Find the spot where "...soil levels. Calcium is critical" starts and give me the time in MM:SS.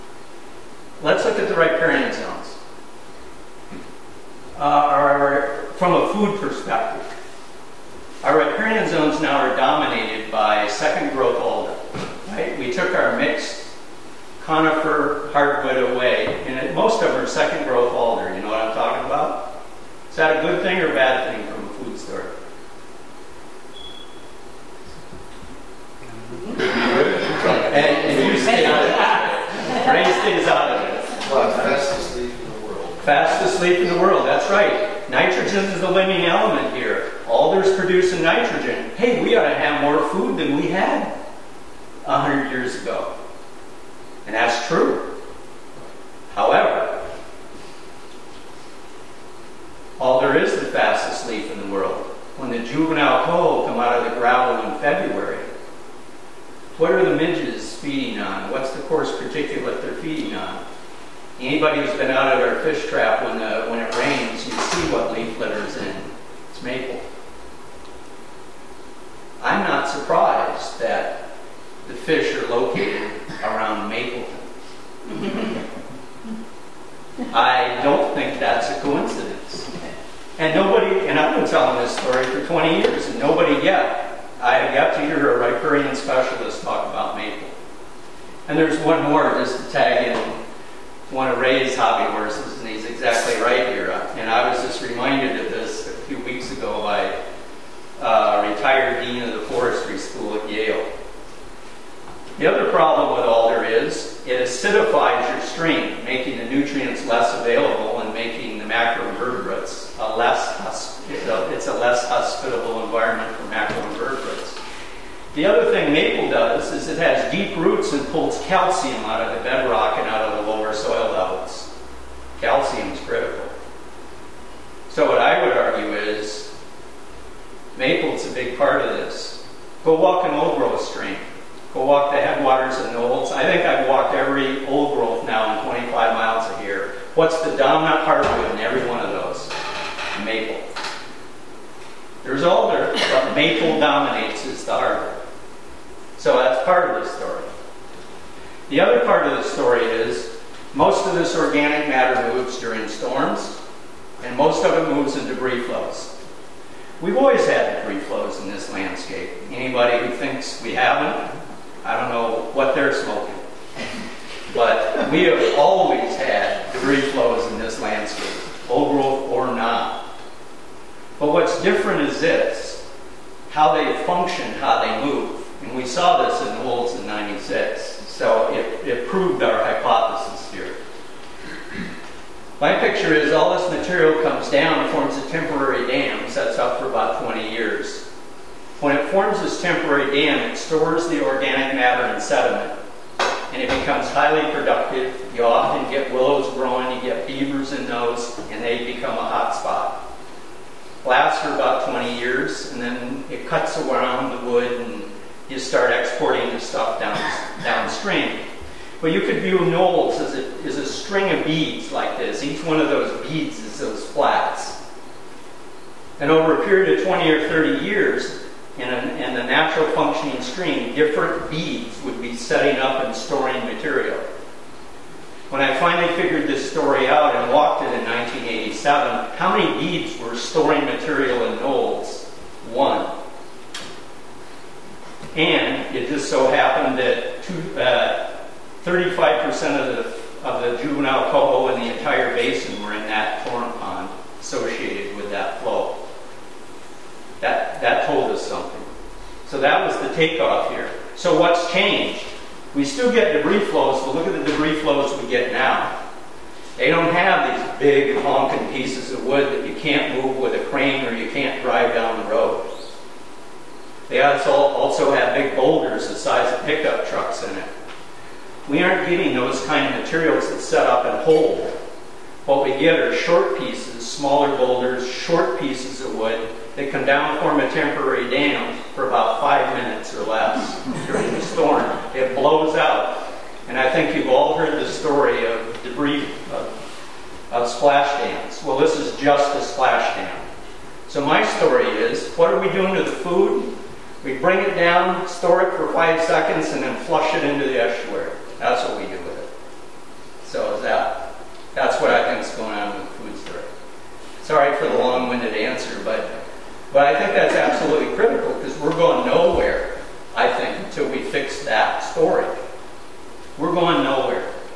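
02:00.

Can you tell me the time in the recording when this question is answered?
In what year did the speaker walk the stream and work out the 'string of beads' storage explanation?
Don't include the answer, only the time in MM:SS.
03:48.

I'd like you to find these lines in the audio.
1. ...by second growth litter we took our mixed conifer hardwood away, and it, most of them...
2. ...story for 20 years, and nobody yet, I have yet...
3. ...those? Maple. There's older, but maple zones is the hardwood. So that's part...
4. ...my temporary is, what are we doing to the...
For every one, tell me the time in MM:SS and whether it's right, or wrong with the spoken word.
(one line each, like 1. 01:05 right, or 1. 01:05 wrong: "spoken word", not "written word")
1. 00:10 wrong: "alder", not "litter"
2. 01:21 right
3. 02:19 wrong: "dominates", not "zones"
4. 04:51 wrong: "story", not "temporary".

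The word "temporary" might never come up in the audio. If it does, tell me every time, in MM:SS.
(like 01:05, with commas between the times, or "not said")
03:05, 03:09, 04:37.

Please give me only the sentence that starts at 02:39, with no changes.
Anybody who thinks we haven't I don't know what they're smoking.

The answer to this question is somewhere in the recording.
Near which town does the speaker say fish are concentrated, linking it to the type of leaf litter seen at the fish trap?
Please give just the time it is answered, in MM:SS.
01:13.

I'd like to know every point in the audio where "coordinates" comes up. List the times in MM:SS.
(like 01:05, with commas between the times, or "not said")
not said.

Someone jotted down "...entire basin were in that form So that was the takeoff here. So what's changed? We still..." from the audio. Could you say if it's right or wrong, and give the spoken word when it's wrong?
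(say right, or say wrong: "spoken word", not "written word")
right.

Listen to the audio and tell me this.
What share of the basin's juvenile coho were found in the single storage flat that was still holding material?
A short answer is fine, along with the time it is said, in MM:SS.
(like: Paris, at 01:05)
35%, at 03:58.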